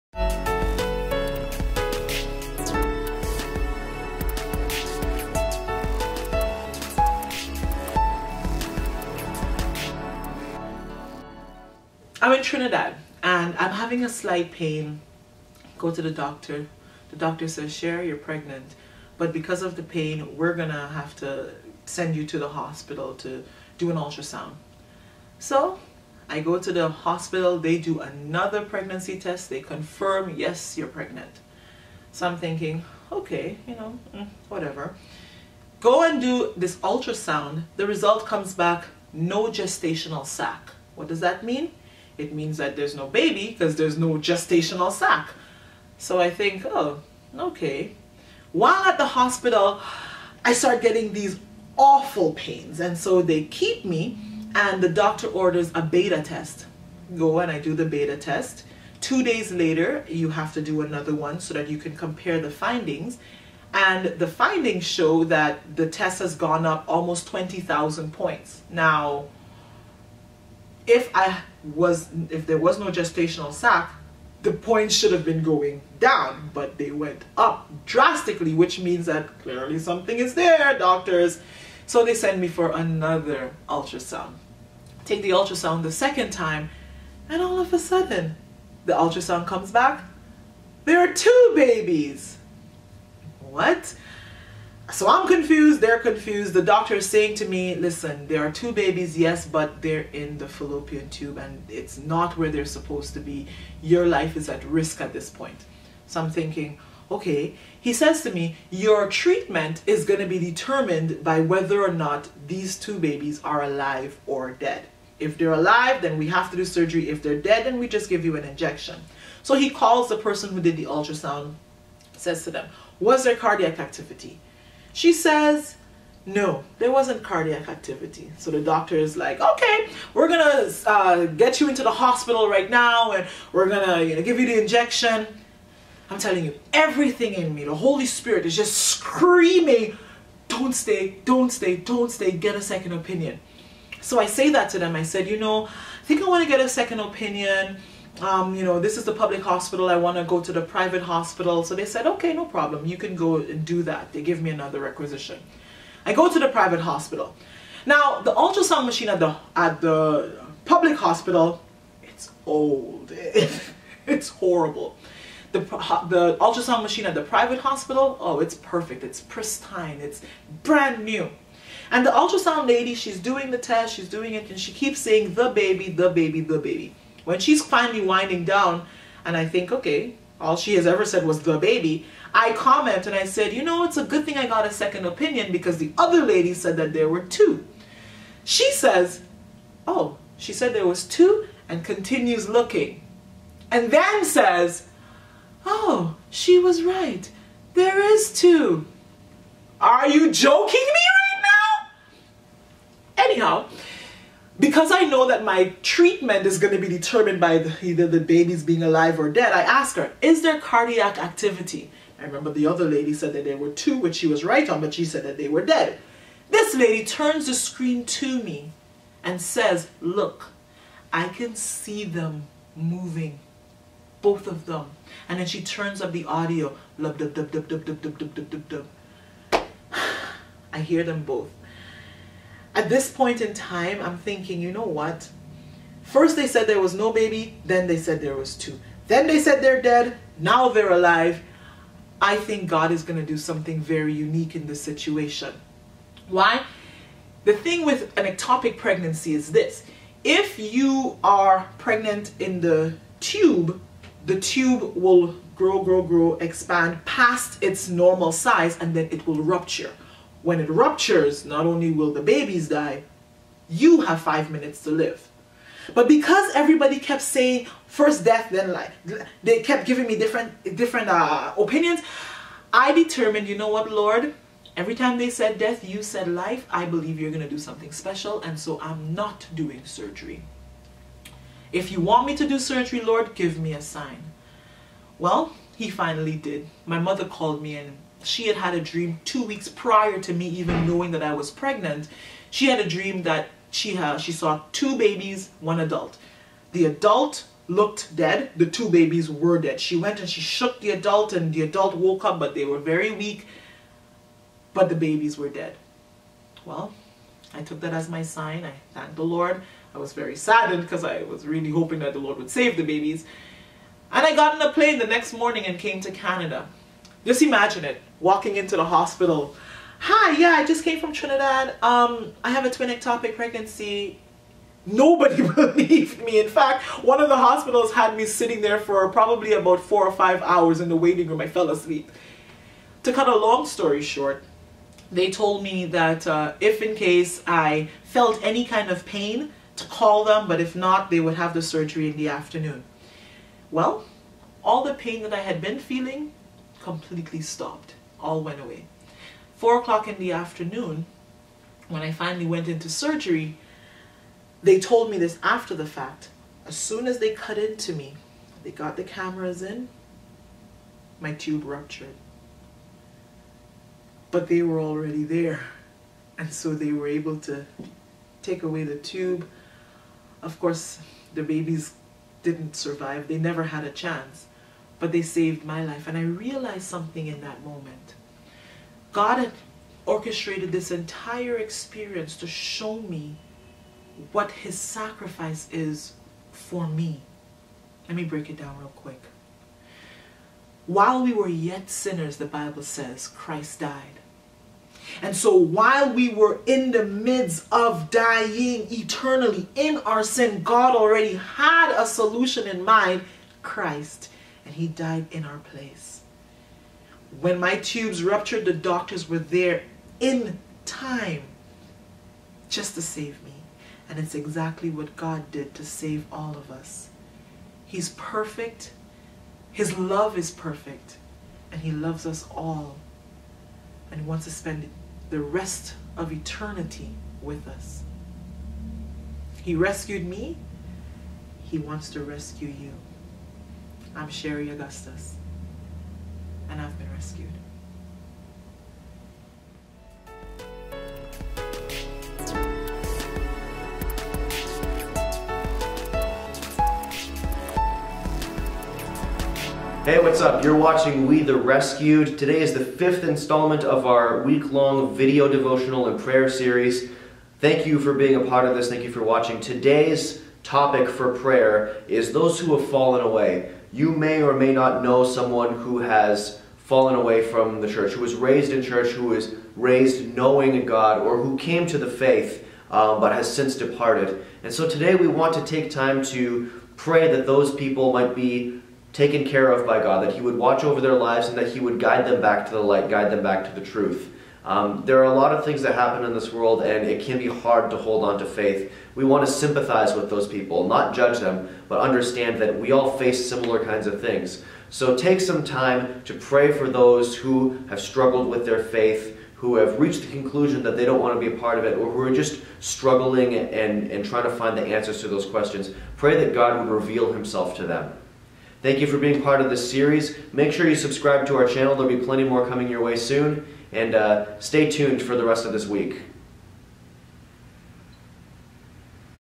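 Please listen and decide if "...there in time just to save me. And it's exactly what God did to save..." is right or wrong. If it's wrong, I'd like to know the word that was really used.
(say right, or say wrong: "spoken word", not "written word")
right.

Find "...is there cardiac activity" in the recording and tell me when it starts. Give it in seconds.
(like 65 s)
210 s.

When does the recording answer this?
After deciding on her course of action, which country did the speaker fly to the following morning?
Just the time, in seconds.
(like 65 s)
316 s.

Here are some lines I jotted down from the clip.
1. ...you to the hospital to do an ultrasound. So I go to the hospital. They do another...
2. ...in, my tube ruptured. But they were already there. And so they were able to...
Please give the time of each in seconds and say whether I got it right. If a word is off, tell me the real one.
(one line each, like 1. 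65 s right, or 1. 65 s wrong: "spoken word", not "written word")
1. 22 s right
2. 359 s right.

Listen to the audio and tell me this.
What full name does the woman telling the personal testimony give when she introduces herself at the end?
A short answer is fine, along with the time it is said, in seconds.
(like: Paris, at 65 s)
Sherry Augustus, at 434 s.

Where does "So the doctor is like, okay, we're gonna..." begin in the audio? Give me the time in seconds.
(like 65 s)
128 s.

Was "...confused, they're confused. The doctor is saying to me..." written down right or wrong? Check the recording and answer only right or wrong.
right.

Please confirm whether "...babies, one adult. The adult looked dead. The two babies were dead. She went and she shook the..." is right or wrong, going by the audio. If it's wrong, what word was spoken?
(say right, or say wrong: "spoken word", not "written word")
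right.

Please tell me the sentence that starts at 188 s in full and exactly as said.
She says, oh, she said there was two and continues looking.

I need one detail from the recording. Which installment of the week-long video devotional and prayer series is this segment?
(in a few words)
Fifth.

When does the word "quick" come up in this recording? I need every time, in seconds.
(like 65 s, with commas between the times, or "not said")
388 s.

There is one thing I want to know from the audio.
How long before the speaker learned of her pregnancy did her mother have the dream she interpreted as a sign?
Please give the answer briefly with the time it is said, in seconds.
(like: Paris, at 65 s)
2 weeks, at 289 s.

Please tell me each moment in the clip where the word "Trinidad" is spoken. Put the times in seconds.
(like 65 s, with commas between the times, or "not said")
12 s, 321 s.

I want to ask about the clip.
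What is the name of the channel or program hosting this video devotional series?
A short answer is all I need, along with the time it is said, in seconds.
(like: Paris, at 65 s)
We the Rescued, at 451 s.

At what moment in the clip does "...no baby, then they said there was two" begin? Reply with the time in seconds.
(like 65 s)
236 s.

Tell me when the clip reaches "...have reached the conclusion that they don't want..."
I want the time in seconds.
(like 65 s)
499 s.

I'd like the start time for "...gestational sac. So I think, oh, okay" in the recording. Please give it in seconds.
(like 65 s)
44 s.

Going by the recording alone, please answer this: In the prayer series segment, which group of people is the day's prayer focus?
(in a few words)
Those who have fallen away.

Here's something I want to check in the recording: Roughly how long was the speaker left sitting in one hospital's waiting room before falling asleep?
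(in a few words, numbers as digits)
4 or 5 hours.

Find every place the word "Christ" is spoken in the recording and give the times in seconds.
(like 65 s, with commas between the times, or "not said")
393 s, 403 s.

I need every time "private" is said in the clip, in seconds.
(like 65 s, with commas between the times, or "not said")
150 s, 156 s, 167 s.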